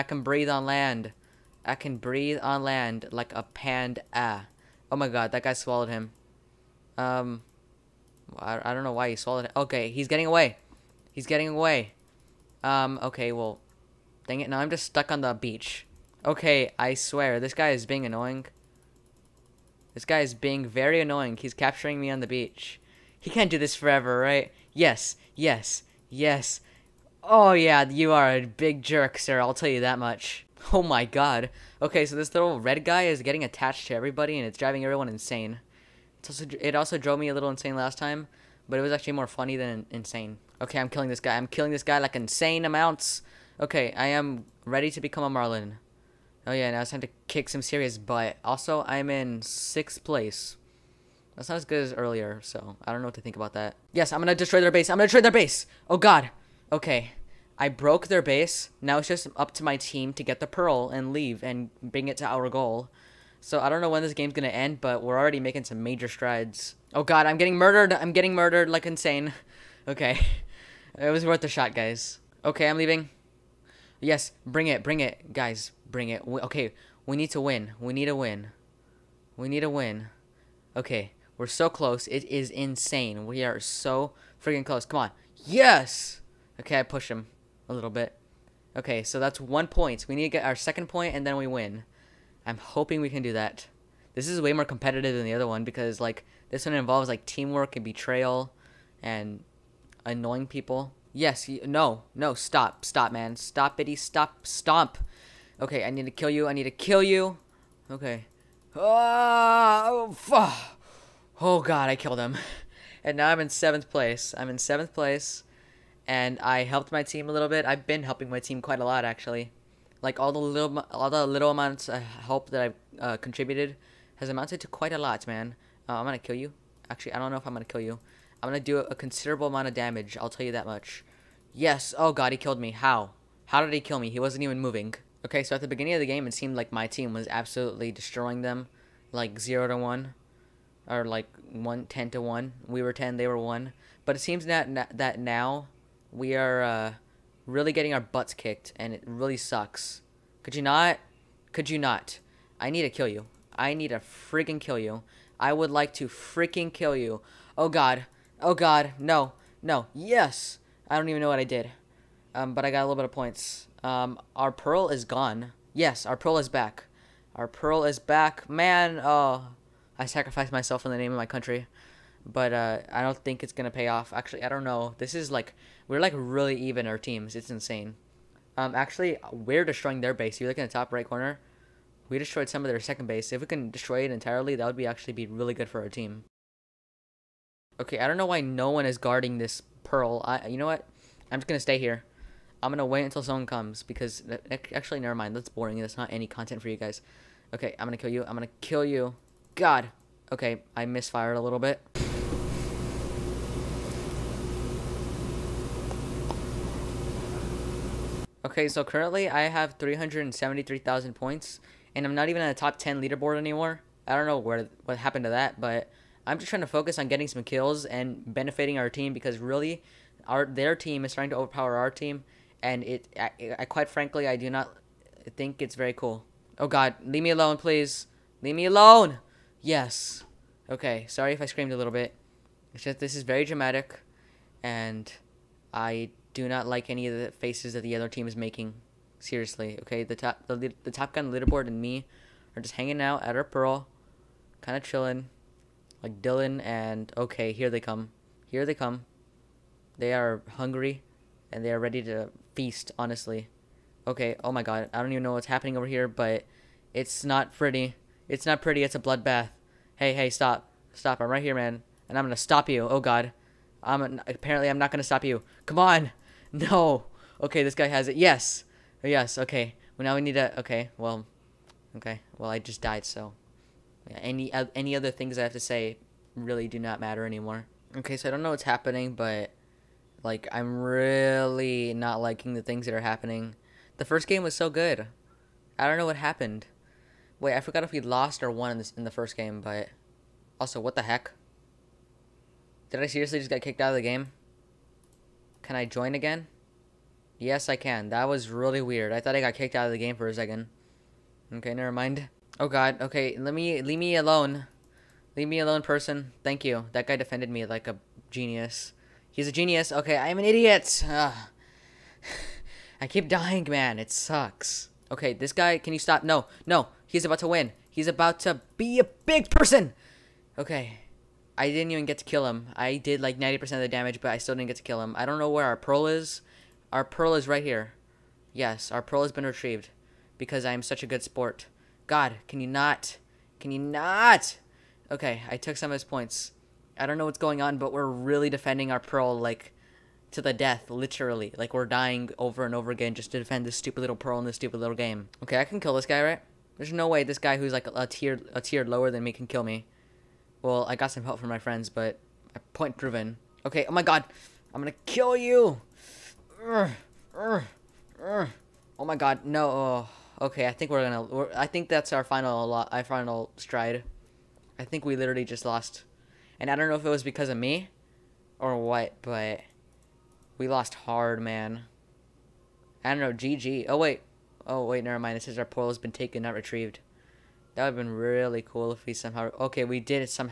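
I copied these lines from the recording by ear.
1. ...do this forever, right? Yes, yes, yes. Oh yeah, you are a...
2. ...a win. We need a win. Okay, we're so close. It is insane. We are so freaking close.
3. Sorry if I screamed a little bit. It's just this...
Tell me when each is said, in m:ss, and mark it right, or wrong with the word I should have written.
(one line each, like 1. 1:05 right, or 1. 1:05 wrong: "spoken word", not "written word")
1. 0:23 right
2. 1:18 right
3. 3:51 right.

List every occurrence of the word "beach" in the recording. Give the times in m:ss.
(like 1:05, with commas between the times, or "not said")
0:15, 0:22.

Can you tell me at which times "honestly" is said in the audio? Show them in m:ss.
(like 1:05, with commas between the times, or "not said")
4:12.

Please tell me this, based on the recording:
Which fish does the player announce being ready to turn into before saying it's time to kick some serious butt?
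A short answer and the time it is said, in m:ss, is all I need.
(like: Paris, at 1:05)
Marlin, at 0:45.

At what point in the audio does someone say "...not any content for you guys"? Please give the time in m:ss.
3:15.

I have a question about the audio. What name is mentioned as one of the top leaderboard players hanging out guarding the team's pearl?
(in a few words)
Dylan.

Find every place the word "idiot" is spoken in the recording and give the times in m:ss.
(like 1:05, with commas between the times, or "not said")
5:10.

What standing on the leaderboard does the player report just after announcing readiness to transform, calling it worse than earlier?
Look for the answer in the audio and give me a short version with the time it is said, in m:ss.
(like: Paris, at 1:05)
sixth place, at 0:49.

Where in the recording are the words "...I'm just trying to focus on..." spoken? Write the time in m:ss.
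3:36.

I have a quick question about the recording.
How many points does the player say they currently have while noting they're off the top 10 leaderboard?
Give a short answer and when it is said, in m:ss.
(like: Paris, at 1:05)
373,000, at 3:29.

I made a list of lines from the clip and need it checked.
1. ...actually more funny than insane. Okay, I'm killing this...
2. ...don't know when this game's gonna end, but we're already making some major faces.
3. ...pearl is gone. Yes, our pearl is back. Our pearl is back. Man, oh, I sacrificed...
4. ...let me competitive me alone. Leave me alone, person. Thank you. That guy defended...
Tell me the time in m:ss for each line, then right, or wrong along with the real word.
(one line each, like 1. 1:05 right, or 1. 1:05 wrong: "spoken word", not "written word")
1. 0:38 right
2. 1:03 wrong: "strides", not "faces"
3. 2:44 right
4. 5:03 wrong: "leave", not "competitive".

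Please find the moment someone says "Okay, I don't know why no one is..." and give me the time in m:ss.
3:07.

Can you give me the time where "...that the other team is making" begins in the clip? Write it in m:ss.
3:57.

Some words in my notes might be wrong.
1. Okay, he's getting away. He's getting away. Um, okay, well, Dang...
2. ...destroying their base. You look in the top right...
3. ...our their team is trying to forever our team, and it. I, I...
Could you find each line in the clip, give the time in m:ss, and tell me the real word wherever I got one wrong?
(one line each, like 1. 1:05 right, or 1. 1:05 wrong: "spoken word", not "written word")
1. 0:09 right
2. 2:59 right
3. 3:40 wrong: "overpower", not "forever".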